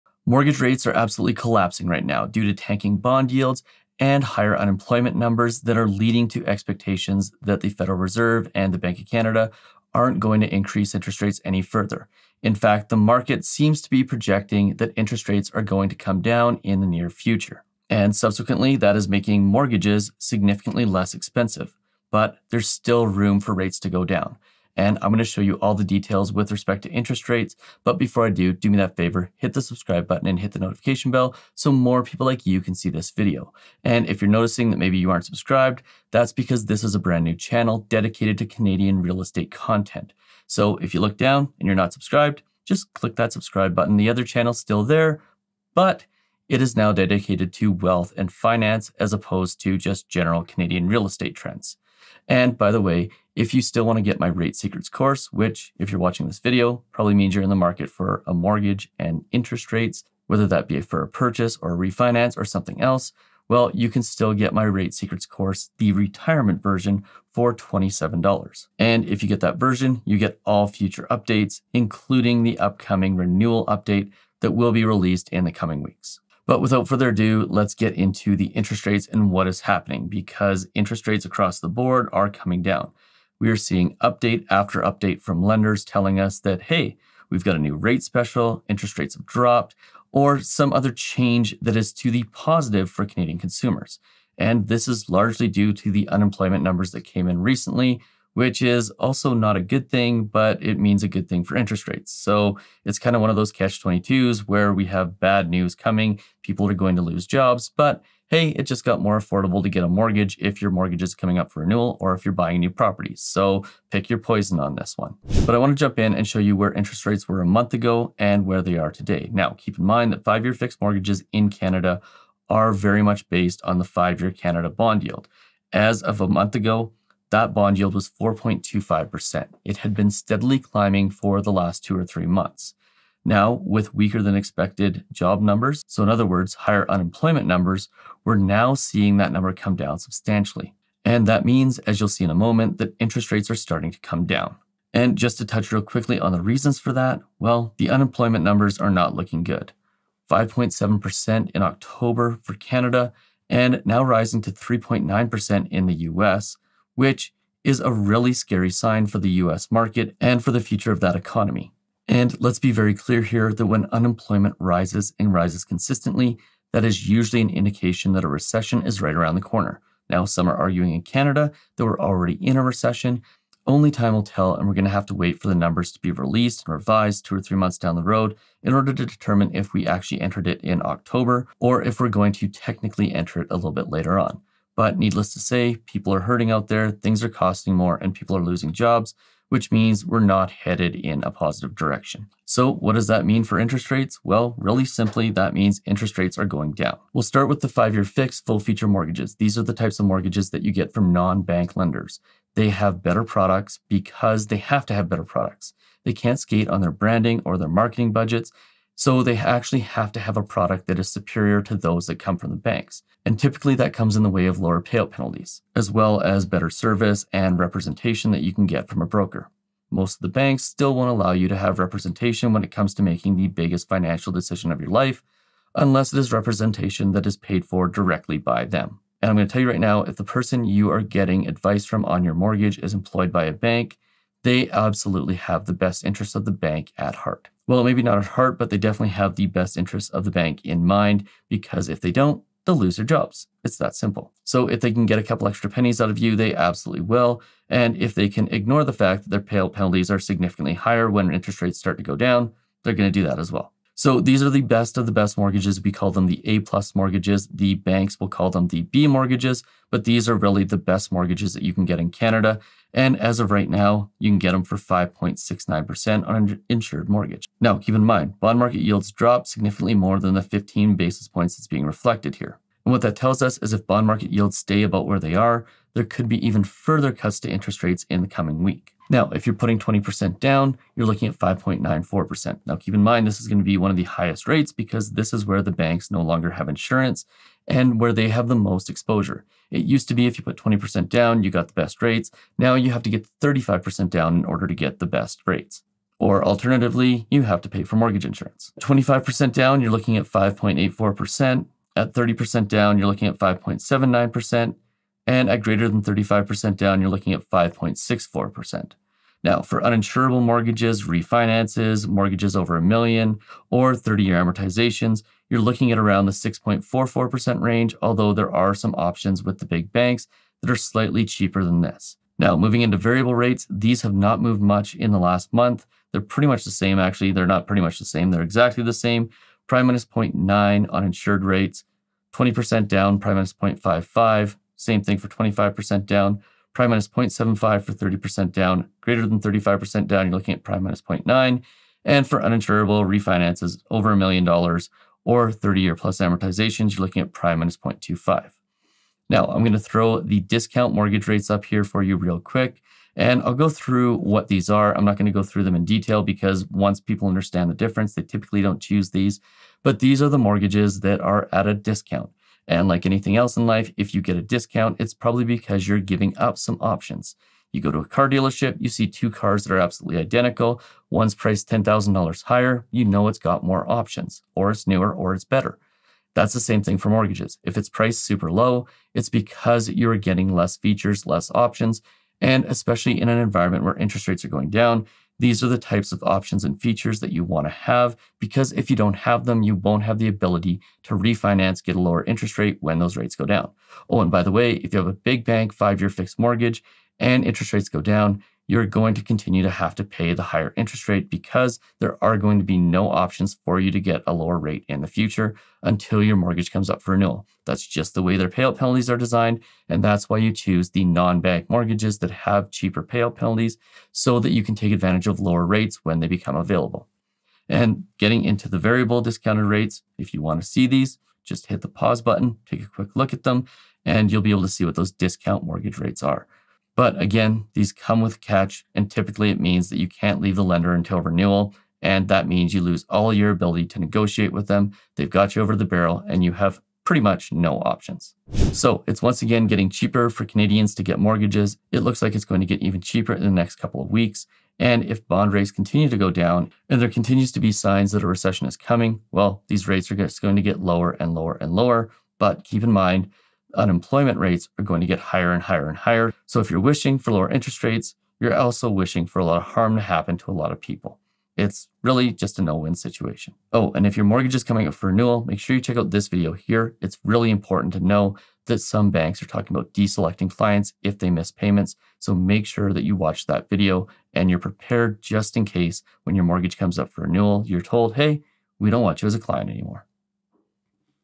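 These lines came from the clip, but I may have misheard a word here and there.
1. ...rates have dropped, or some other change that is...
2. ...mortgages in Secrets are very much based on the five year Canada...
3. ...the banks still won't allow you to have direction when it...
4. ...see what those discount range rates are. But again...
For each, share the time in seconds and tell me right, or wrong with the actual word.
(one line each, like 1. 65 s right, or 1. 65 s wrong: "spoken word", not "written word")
1. 88 s right
2. 120 s wrong: "Canada", not "Secrets"
3. 220 s wrong: "representation", not "direction"
4. 424 s wrong: "mortgage", not "range".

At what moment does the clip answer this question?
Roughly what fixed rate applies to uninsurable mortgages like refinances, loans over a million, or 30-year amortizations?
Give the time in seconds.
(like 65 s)
316 s.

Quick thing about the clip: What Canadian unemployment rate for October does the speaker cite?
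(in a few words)
5.7%.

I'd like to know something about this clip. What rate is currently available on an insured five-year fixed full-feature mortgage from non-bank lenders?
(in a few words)
5.69%.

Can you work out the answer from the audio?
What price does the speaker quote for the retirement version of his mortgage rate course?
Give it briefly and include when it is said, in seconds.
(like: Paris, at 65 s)
$27, at 67 s.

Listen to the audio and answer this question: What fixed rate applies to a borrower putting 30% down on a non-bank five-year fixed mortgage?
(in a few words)
5.79%.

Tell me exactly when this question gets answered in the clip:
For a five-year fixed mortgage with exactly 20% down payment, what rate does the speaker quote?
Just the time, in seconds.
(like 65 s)
281 s.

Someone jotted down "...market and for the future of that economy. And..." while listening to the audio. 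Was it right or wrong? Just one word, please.
right.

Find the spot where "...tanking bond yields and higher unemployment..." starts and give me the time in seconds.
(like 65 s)
2 s.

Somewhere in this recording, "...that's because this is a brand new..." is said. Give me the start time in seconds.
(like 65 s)
36 s.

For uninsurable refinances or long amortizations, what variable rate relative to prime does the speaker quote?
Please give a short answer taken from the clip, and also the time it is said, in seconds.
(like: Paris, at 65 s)
prime minus 0.25, at 347 s.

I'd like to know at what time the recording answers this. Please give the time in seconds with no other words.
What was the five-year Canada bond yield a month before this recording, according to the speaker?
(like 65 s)
128 s.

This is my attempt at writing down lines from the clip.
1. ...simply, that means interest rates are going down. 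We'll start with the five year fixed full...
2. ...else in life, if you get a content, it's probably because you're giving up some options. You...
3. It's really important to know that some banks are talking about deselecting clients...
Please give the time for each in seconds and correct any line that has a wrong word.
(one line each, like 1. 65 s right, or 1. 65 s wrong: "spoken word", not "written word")
1. 194 s right
2. 363 s wrong: "discount", not "content"
3. 467 s right.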